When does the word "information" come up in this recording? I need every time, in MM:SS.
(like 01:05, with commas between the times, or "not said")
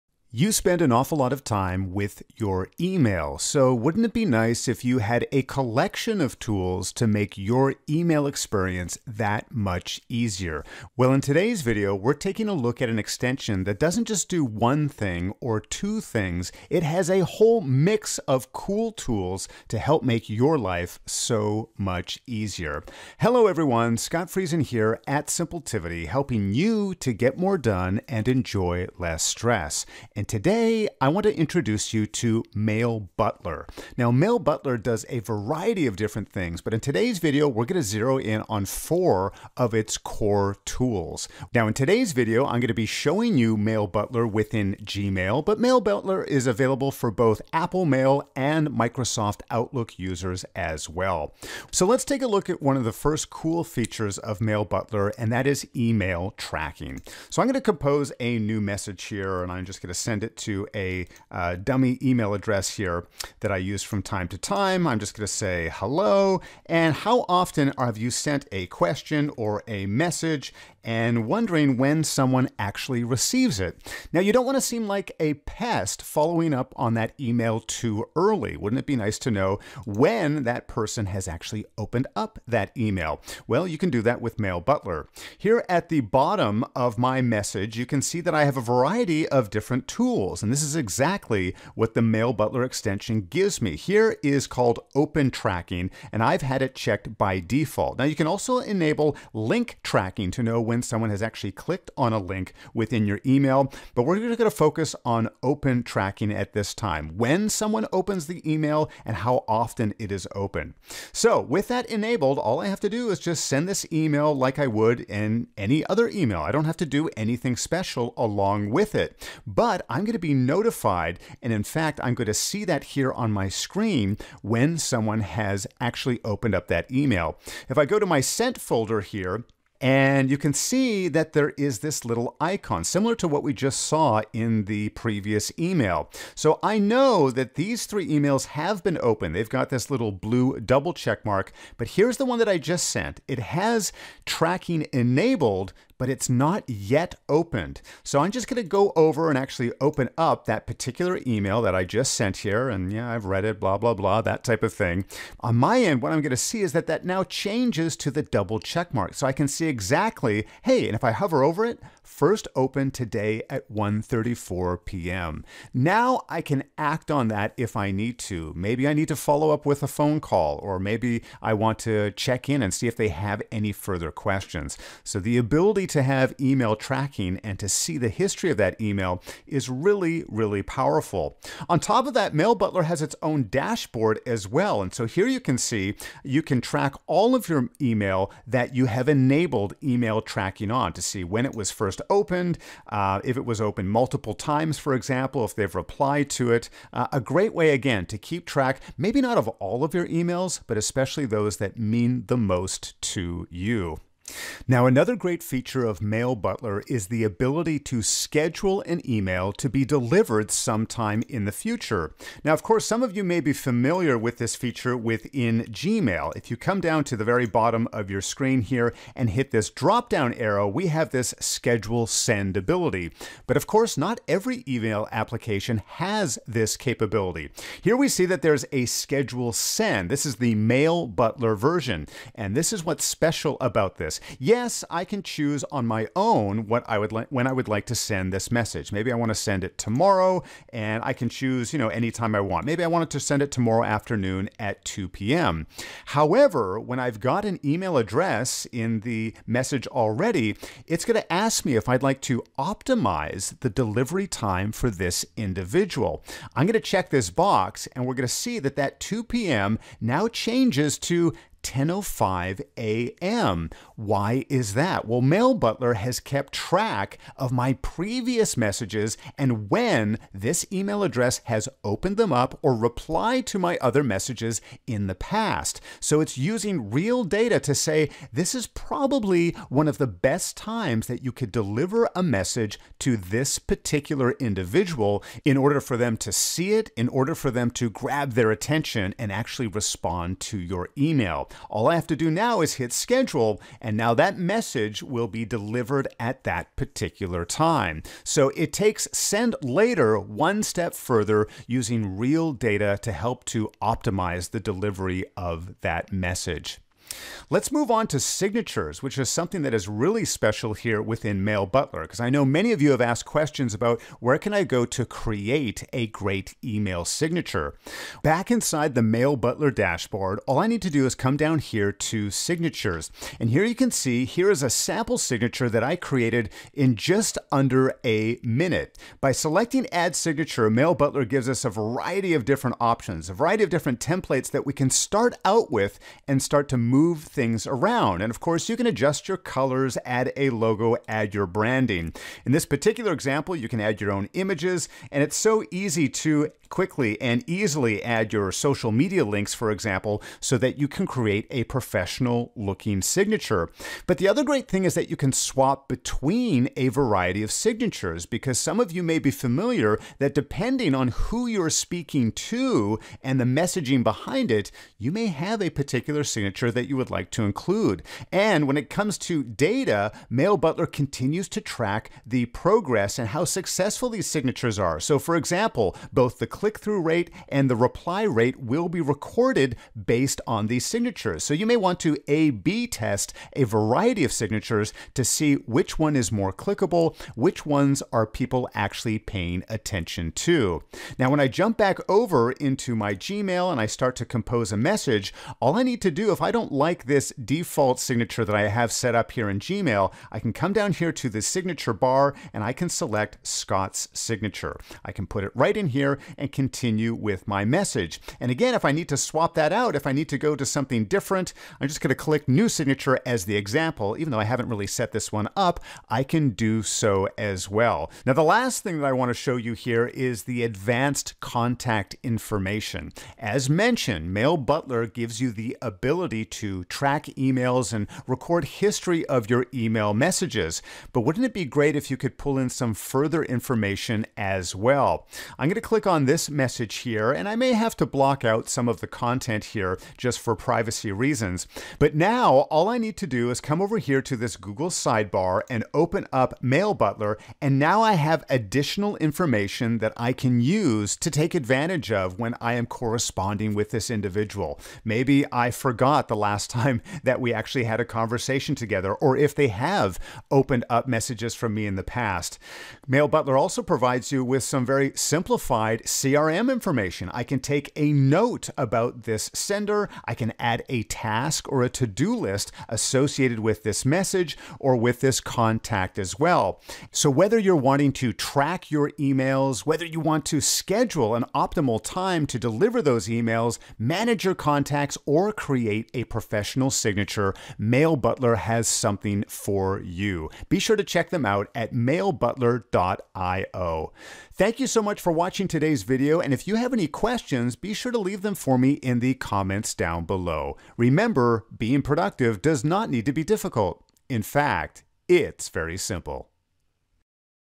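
07:02, 07:13, 07:29, 07:46.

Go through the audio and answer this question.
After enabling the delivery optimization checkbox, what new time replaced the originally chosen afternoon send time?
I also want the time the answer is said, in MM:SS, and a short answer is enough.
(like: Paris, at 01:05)
10:05 a.m., at 04:21.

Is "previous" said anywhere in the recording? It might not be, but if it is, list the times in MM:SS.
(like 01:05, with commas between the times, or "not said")
02:14, 04:27.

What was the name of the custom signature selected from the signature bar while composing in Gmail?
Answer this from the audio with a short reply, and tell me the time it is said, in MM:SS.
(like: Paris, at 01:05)
Scott's signature, at 06:43.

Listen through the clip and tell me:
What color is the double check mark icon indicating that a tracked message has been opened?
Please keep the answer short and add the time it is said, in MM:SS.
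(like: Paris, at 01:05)
Blue, at 02:20.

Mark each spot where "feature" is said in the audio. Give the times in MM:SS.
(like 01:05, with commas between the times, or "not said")
00:53, 03:25, 03:34.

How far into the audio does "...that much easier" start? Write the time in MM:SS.
00:09.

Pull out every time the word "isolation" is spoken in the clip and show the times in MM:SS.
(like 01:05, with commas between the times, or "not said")
not said.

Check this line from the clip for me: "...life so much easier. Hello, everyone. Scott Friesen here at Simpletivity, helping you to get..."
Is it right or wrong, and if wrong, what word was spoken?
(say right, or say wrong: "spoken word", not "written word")
right.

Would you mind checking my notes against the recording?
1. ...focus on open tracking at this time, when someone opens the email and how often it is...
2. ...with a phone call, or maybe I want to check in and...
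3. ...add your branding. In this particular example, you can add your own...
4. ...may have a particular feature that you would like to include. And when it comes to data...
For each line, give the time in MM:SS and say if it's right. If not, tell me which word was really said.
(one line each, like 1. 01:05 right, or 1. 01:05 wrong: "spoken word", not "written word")
1. 01:44 right
2. 02:49 right
3. 05:41 right
4. 06:05 wrong: "signature", not "feature".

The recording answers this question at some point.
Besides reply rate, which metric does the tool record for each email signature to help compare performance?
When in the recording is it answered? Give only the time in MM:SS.
06:16.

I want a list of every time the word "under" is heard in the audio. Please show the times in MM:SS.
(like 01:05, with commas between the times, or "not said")
05:27.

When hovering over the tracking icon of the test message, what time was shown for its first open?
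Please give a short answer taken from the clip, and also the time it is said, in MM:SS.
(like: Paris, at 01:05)
1:34 p.m., at 02:43.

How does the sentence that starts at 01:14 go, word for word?
Now, you don't want to seem like a pest following up on that email too early.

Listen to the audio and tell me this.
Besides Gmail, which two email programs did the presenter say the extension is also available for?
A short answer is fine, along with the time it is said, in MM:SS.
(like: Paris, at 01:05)
Apple Mail and Microsoft Outlook, at 00:47.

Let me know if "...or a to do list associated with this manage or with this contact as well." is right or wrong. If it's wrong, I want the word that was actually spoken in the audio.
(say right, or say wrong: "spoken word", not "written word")
wrong: "message", not "manage".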